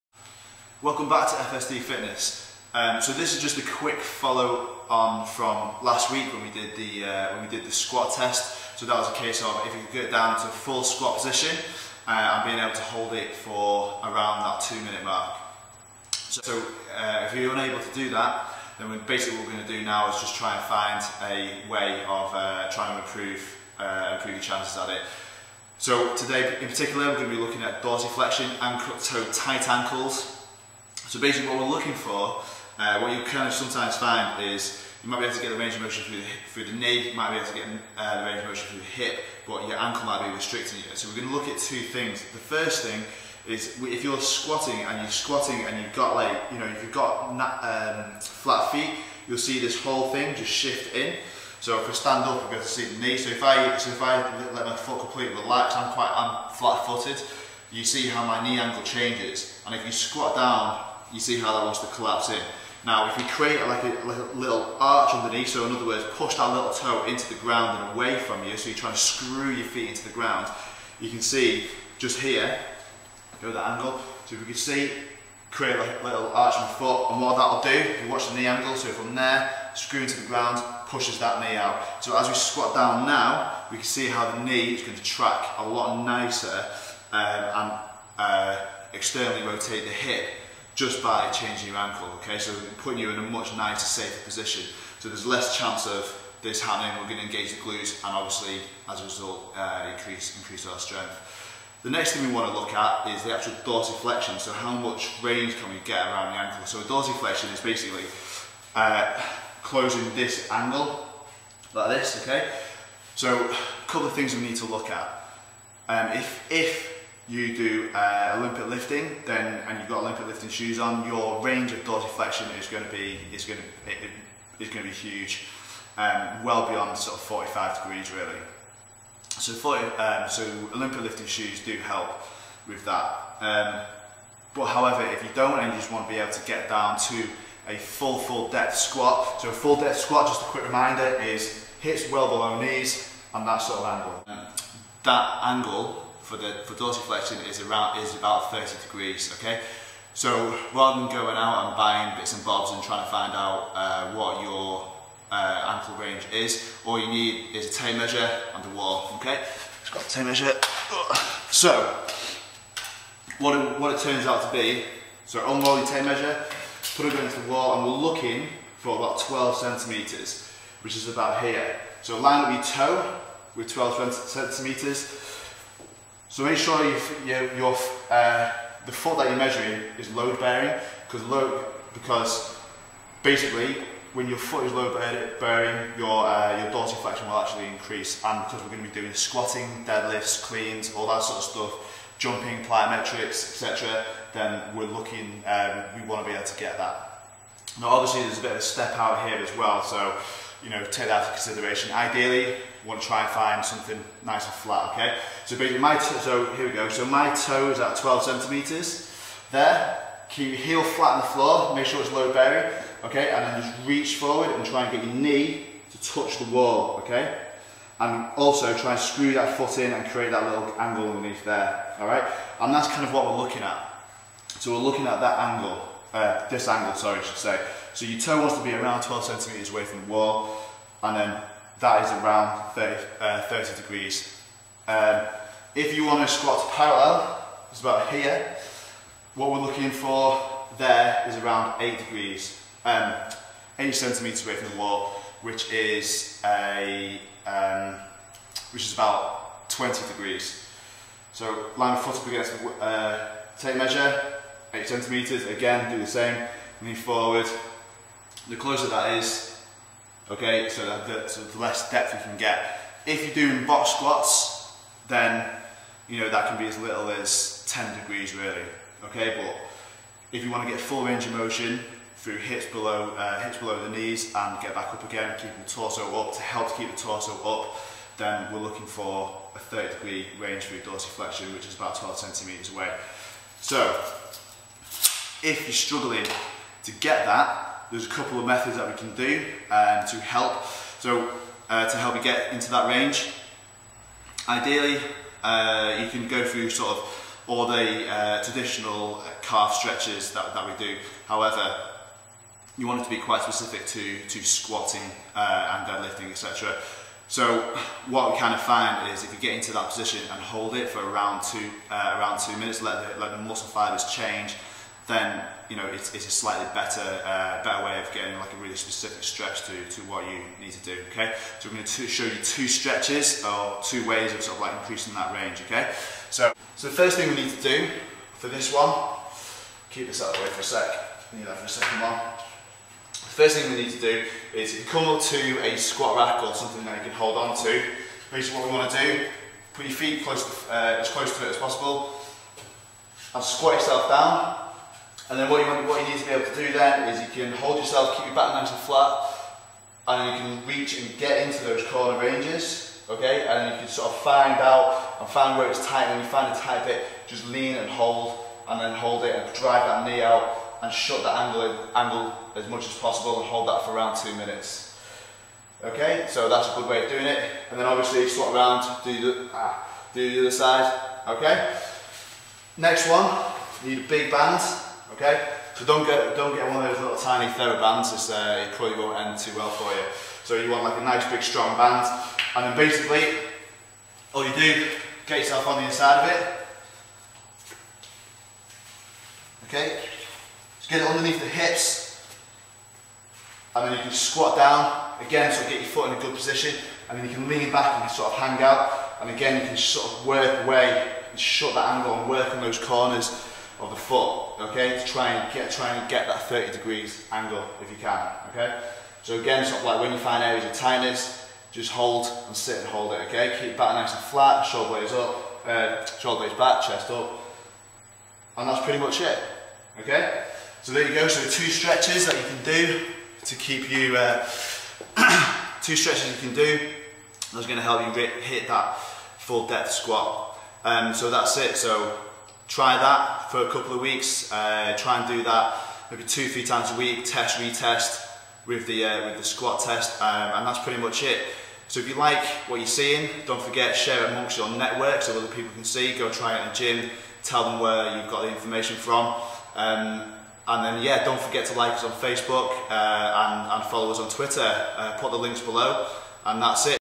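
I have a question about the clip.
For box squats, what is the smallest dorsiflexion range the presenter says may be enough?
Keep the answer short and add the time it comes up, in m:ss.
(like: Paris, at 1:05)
10 degrees, at 4:27.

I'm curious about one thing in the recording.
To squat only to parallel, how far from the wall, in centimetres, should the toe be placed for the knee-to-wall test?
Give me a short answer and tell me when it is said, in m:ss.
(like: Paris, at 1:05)
8 centimetres, at 4:03.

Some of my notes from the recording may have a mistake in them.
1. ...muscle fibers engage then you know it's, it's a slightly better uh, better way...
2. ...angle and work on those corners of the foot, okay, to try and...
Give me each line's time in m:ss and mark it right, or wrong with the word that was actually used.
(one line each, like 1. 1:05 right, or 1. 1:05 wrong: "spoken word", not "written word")
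1. 5:13 wrong: "change", not "engage"
2. 6:41 right.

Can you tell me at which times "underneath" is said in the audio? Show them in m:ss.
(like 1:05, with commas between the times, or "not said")
1:05, 3:41, 6:31.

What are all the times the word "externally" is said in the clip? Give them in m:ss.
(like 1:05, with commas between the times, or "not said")
1:28.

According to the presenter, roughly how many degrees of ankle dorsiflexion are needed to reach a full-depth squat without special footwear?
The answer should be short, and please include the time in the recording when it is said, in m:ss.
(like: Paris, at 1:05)
30 degrees, at 2:28.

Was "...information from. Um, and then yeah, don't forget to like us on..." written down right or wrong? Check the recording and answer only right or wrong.
right.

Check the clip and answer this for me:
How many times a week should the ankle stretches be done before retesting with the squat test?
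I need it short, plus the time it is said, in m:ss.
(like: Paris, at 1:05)
2 to 3 times, at 7:16.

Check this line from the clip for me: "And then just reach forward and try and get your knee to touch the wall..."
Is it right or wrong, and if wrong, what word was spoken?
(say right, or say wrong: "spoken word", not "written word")
right.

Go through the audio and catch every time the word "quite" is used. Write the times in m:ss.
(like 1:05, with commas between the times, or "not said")
0:55, 5:03.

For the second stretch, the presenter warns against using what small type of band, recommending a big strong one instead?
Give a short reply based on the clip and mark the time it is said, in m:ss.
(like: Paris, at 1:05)
Therabands, at 6:17.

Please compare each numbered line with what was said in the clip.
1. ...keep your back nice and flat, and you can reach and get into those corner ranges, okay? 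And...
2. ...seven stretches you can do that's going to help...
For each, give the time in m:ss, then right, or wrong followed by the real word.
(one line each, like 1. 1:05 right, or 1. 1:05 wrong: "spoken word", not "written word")
1. 5:48 right
2. 7:05 wrong: "two", not "seven".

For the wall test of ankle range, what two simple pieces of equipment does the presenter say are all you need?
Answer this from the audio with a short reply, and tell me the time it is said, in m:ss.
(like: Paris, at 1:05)
A tape measure and a wall, at 2:37.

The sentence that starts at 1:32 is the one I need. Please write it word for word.
So putting you in a much nicer, safer position.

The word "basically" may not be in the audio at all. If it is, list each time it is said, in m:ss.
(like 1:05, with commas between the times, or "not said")
0:19, 0:31, 1:47, 3:03, 3:25, 5:38, 6:22.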